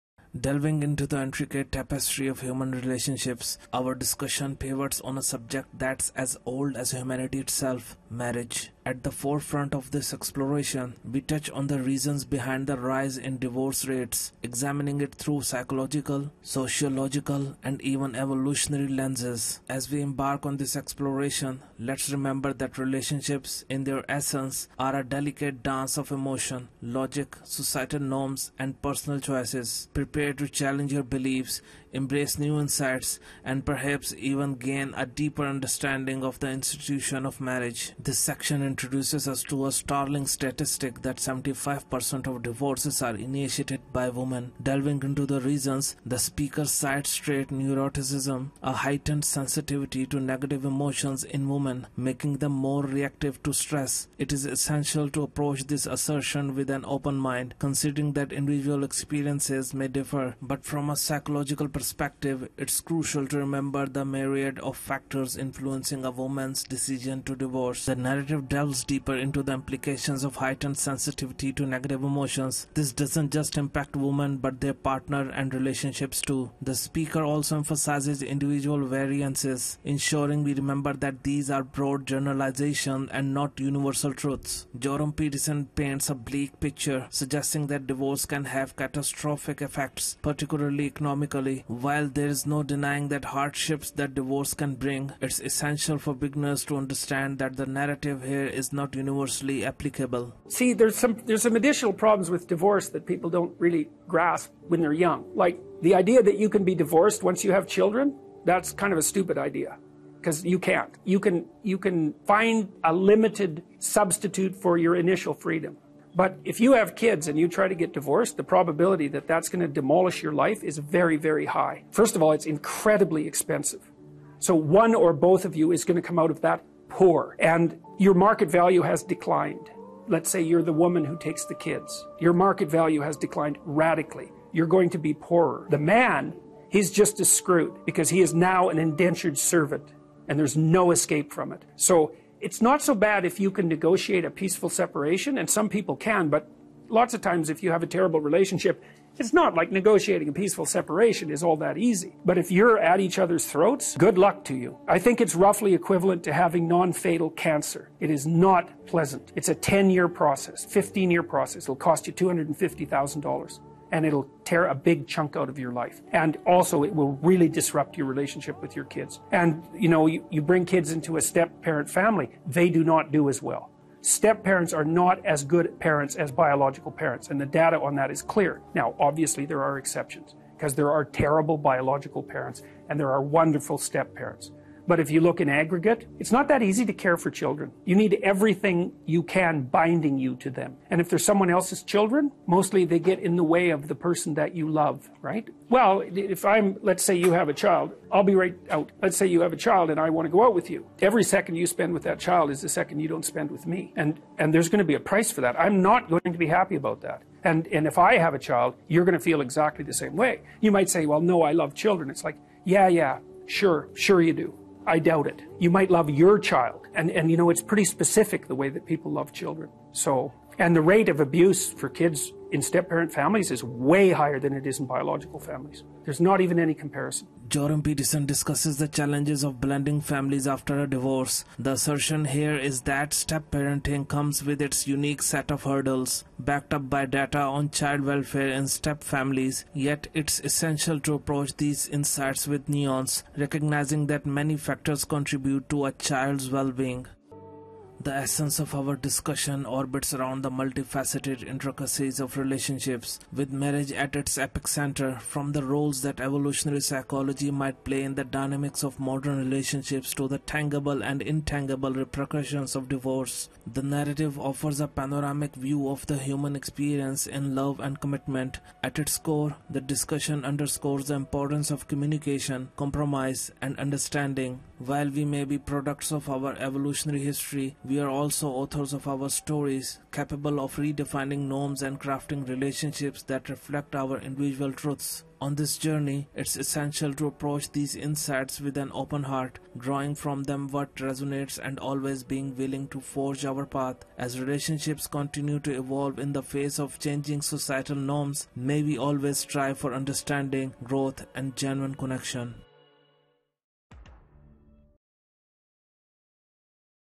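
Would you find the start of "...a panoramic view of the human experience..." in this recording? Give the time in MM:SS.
04:24.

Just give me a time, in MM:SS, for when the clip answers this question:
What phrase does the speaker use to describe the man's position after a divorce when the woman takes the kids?
02:18.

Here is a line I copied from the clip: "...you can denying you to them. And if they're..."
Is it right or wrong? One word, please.
wrong.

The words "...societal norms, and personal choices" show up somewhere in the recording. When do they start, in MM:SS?
00:27.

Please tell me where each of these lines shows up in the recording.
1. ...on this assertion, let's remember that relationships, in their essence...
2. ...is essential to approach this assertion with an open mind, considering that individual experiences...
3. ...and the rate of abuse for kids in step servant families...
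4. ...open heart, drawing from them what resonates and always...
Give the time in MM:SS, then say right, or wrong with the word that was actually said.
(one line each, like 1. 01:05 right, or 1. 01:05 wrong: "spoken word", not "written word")
1. 00:20 wrong: "exploration", not "assertion"
2. 00:54 right
3. 03:40 wrong: "parent", not "servant"
4. 04:48 right.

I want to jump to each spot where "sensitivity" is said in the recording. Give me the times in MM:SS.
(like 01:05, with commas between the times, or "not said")
00:49, 01:10.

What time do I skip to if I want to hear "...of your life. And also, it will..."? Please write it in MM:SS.
02:45.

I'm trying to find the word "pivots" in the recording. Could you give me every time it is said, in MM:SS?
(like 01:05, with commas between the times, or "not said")
00:04.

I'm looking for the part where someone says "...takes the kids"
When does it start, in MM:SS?
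02:11.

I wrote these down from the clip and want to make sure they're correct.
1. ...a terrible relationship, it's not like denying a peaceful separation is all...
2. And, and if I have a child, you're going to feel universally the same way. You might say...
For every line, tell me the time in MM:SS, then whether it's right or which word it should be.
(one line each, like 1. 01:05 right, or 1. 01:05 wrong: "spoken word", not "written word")
1. 02:27 wrong: "negotiating", not "denying"
2. 03:27 wrong: "exactly", not "universally".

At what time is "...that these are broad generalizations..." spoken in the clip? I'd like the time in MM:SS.
01:20.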